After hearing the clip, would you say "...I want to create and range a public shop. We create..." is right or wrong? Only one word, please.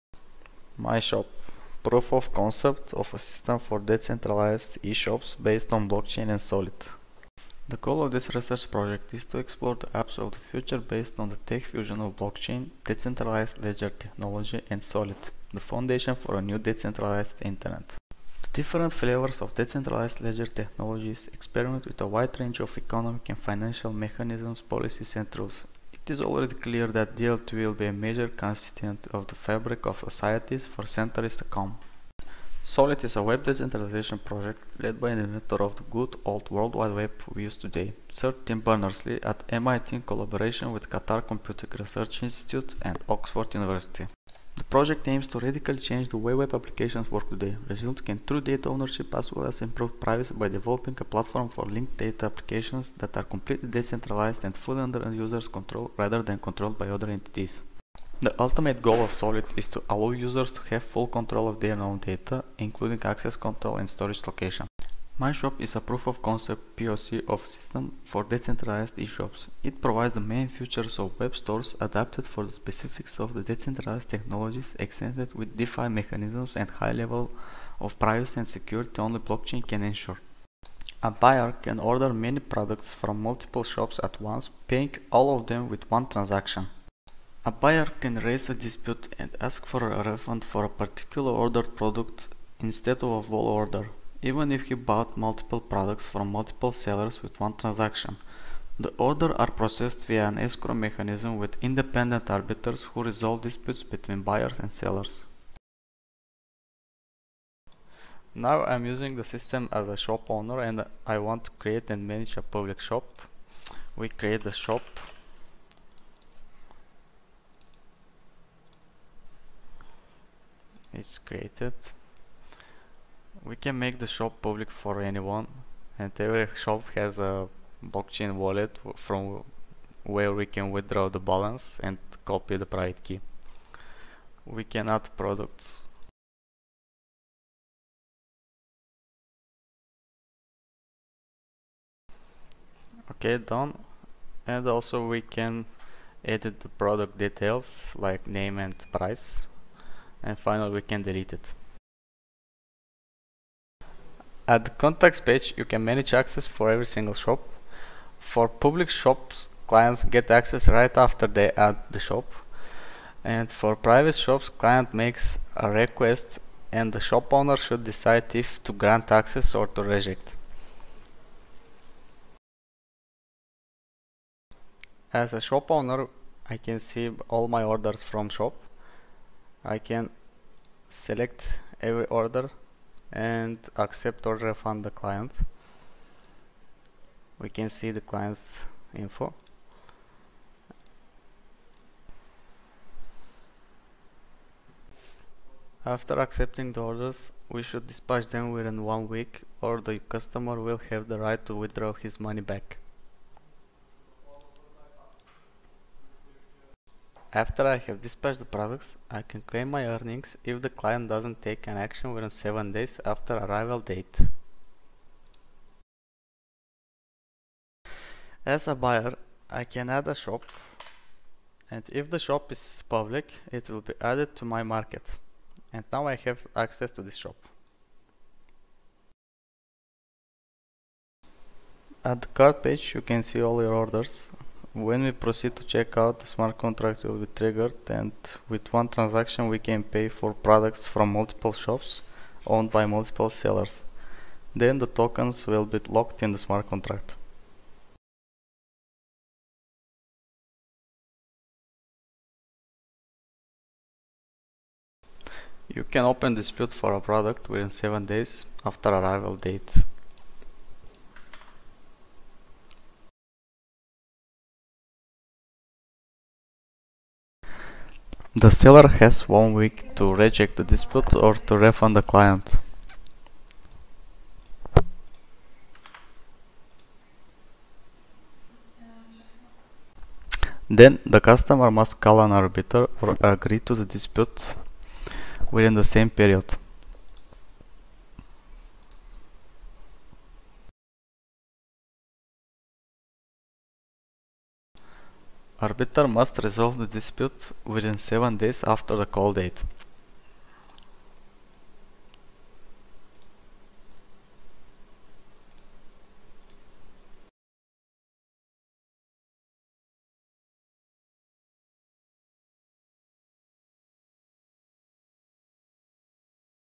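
wrong.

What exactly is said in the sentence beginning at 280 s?
Then the customer must call an arbiter or agree to the dispute within the same period.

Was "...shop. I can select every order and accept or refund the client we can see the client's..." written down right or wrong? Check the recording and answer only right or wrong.
right.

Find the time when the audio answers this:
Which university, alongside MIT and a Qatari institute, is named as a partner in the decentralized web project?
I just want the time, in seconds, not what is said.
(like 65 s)
43 s.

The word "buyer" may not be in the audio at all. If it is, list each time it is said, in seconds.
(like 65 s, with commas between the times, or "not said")
81 s, 87 s, 104 s, 218 s.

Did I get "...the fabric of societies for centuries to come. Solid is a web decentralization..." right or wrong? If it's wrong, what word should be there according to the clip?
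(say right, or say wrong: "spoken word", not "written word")
right.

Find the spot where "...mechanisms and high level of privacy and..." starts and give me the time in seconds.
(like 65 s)
75 s.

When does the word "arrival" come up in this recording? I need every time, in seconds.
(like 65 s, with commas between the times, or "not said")
213 s, 258 s.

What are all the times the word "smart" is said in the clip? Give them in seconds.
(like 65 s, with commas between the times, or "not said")
236 s, 246 s.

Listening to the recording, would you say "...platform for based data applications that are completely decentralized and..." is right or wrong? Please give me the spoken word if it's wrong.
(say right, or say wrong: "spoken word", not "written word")
wrong: "linked", not "based".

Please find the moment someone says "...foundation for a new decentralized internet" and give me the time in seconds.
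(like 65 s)
15 s.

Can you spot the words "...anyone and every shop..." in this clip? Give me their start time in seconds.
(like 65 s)
125 s.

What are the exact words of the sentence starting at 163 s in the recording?
And for private shops, client makes a request and the shop owner should decide if to grant access or to reject.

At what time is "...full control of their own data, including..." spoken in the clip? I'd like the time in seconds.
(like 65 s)
60 s.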